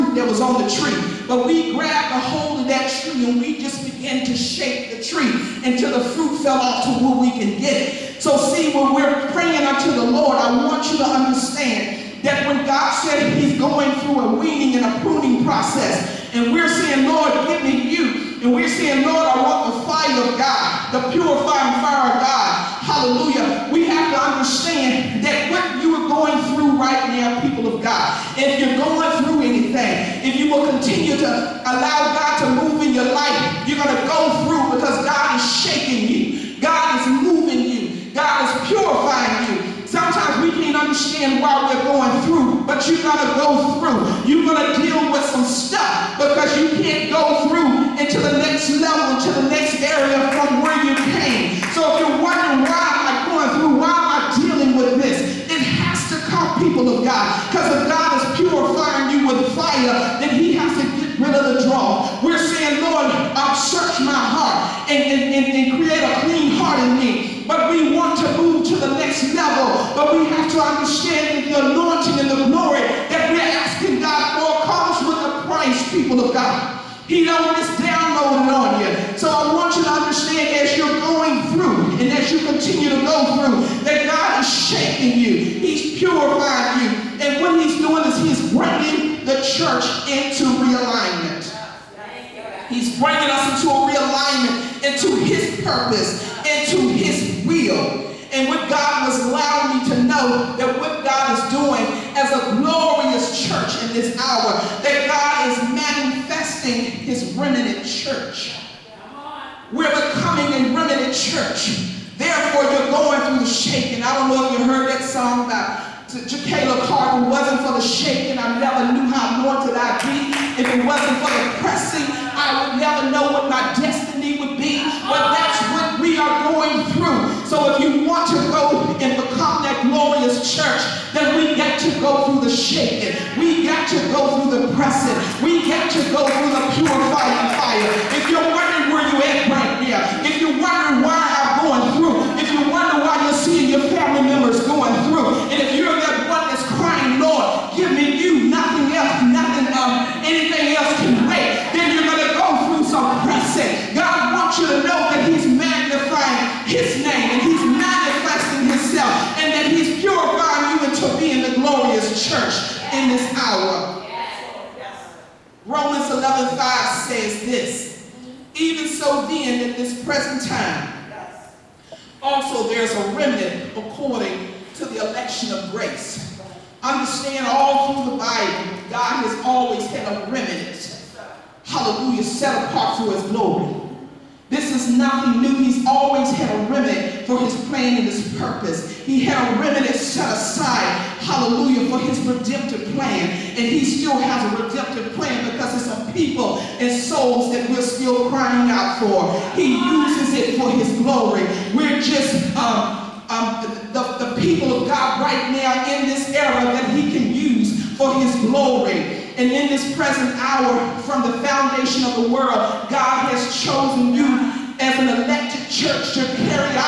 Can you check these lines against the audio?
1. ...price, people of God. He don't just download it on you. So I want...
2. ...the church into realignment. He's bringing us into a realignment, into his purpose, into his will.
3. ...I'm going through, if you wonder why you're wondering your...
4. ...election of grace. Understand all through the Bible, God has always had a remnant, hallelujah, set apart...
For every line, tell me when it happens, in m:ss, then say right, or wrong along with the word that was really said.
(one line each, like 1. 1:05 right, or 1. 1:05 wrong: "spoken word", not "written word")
1. 1:15 right
2. 1:29 right
3. 2:21 wrong: "seeing", not "wondering"
4. 2:55 right.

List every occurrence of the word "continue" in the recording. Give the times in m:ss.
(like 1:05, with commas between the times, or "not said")
0:30, 1:22.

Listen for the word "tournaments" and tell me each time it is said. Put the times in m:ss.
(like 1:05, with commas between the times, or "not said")
not said.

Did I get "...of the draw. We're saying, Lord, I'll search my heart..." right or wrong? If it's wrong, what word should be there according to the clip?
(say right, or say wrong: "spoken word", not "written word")
right.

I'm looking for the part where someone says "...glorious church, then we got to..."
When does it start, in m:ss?
2:09.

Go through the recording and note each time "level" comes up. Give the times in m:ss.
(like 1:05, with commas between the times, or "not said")
0:48, 1:09.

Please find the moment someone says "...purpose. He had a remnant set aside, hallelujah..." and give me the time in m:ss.
3:08.